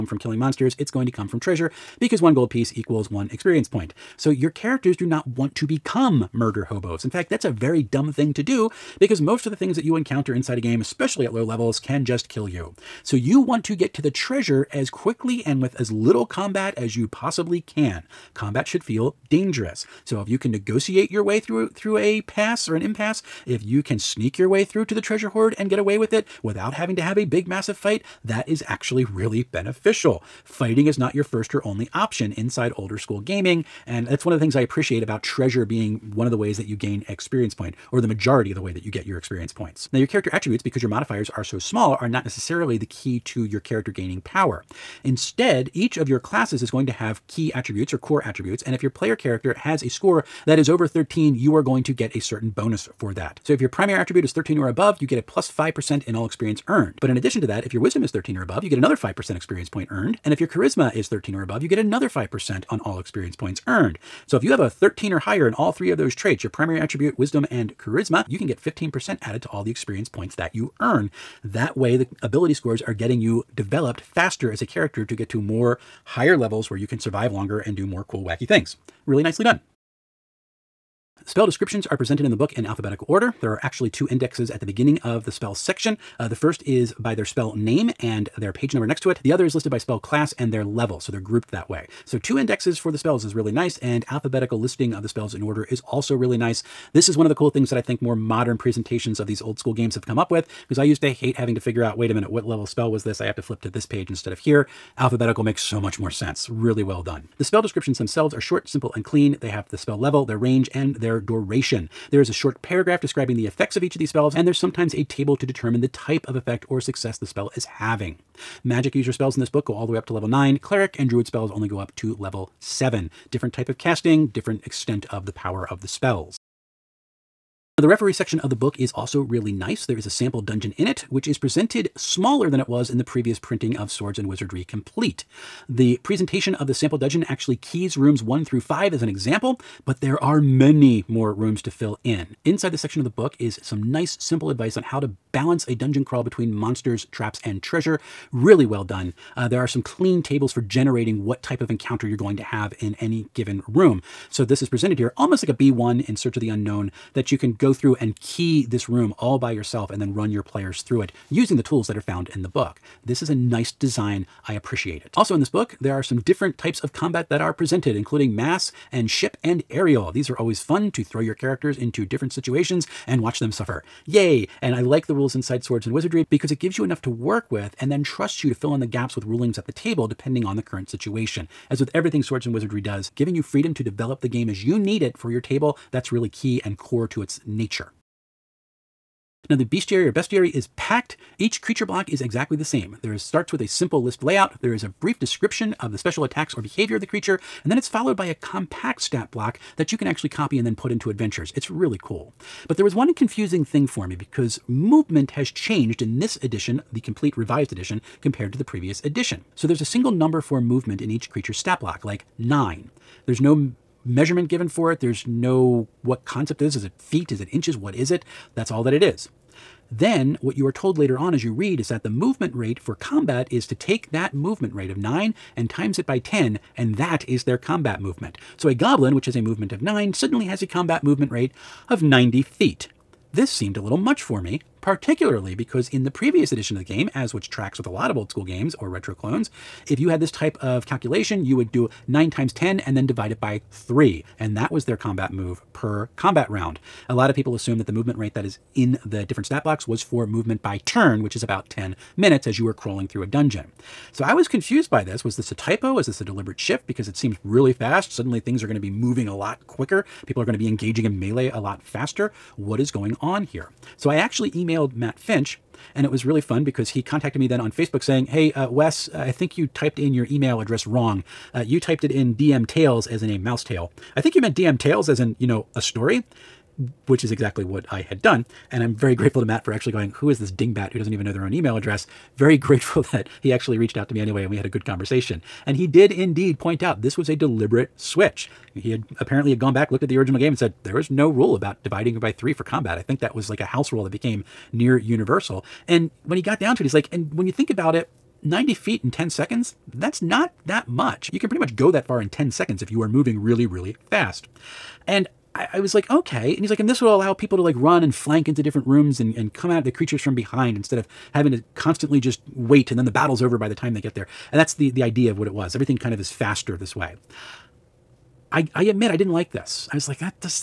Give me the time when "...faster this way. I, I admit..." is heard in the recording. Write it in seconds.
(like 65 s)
316 s.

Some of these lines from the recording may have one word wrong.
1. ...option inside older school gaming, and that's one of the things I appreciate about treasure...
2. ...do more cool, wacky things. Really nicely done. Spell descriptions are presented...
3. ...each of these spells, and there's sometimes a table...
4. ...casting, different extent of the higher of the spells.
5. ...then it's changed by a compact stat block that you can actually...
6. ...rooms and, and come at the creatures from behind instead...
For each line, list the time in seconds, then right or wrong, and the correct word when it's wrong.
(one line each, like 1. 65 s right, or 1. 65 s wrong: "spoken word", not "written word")
1. 31 s right
2. 77 s right
3. 113 s right
4. 123 s wrong: "power", not "higher"
5. 197 s wrong: "followed", not "changed"
6. 308 s right.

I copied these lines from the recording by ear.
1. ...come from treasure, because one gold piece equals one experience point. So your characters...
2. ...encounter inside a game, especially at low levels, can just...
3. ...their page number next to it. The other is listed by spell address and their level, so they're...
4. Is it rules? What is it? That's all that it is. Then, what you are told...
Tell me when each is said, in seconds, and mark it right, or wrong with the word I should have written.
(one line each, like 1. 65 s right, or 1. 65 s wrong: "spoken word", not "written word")
1. 1 s right
2. 9 s right
3. 88 s wrong: "class", not "address"
4. 217 s wrong: "inches", not "rules".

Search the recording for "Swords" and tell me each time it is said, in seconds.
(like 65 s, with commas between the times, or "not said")
133 s, 175 s, 182 s.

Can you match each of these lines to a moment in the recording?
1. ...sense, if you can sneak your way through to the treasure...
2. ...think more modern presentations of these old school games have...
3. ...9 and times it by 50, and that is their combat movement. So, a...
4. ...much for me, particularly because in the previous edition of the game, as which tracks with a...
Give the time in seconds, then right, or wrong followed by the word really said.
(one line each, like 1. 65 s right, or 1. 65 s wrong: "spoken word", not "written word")
1. 22 s wrong: "impasse", not "sense"
2. 97 s right
3. 224 s wrong: "10", not "50"
4. 233 s right.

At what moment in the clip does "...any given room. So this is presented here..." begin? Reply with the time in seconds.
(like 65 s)
153 s.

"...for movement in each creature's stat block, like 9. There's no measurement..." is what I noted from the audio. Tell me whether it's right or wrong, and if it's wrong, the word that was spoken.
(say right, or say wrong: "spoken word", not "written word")
right.